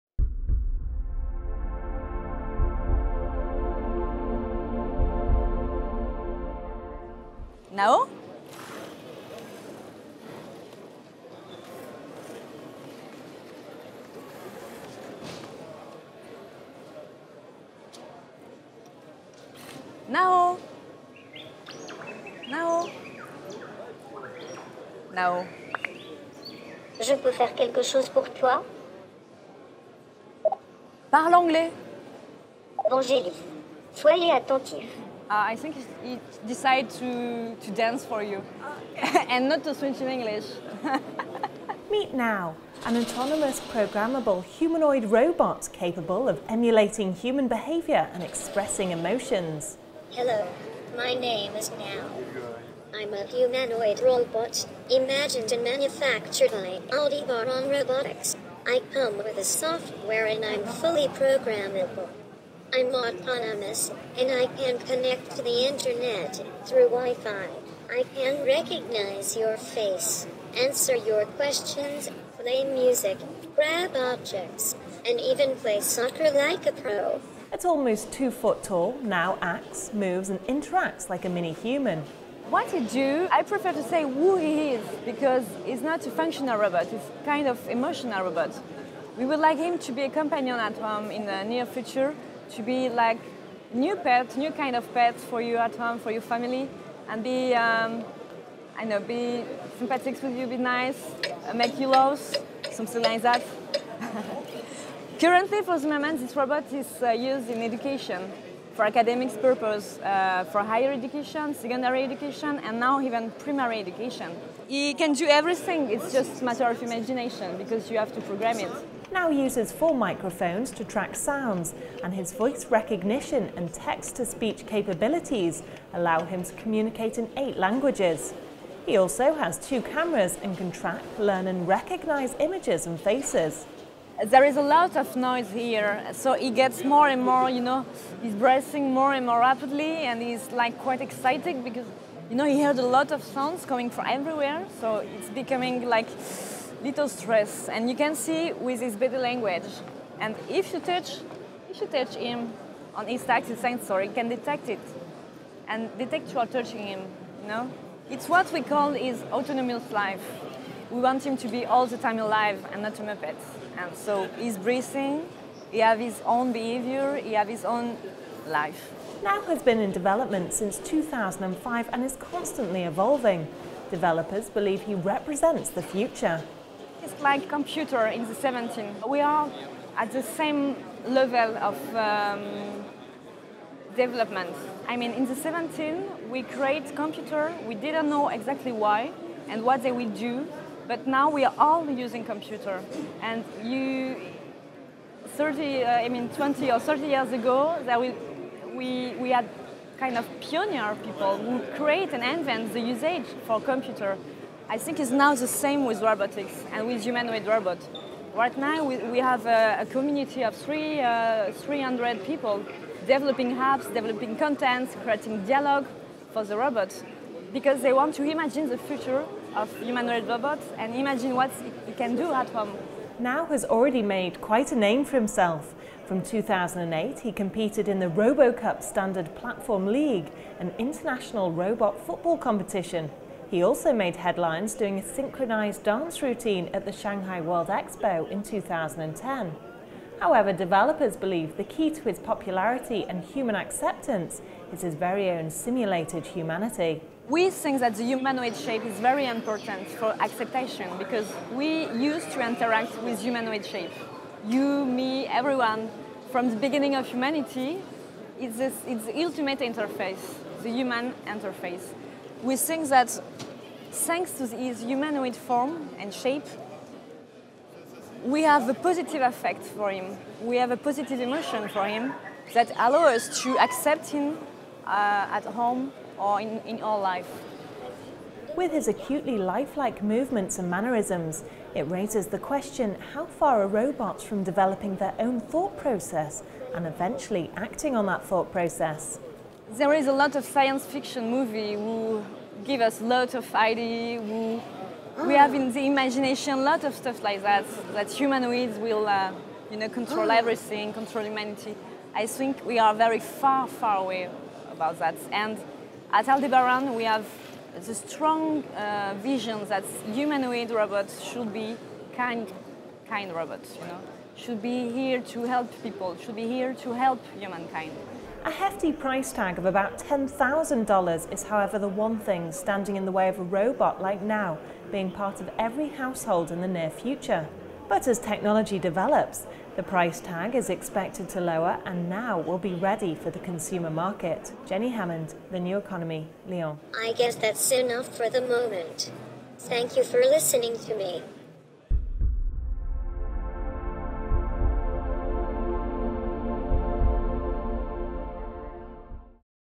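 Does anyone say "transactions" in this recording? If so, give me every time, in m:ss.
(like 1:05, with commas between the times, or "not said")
not said.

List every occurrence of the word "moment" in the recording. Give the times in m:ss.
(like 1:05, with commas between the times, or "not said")
1:45, 5:38.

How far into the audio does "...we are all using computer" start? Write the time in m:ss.
3:11.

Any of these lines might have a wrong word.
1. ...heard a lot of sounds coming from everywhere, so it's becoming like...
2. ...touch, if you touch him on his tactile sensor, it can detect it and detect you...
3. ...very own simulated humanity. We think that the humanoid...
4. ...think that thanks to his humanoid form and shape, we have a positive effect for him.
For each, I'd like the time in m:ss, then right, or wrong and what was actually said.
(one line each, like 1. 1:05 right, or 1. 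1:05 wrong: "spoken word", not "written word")
1. 2:22 right
2. 2:30 right
3. 4:04 right
4. 4:22 right.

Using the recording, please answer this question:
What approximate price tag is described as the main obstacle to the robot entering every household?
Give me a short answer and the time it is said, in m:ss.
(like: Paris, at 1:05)
$10,000, at 5:19.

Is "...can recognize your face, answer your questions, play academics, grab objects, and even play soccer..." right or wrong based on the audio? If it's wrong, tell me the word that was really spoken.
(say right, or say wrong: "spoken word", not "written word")
wrong: "music", not "academics".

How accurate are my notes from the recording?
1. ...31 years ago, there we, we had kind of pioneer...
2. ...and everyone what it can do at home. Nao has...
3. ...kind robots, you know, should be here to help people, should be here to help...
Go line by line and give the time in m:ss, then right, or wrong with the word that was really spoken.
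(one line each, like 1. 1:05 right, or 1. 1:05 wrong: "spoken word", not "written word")
1. 3:16 wrong: "30", not "31"
2. 3:40 wrong: "imagine", not "everyone"
3. 5:13 right.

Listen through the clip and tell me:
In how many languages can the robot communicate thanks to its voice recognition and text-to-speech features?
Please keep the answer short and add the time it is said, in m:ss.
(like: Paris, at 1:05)
8, at 2:07.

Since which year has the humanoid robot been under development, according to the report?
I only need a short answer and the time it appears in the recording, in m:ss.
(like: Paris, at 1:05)
2005, at 2:50.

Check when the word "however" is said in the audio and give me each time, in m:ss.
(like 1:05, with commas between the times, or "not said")
4:00, 5:21.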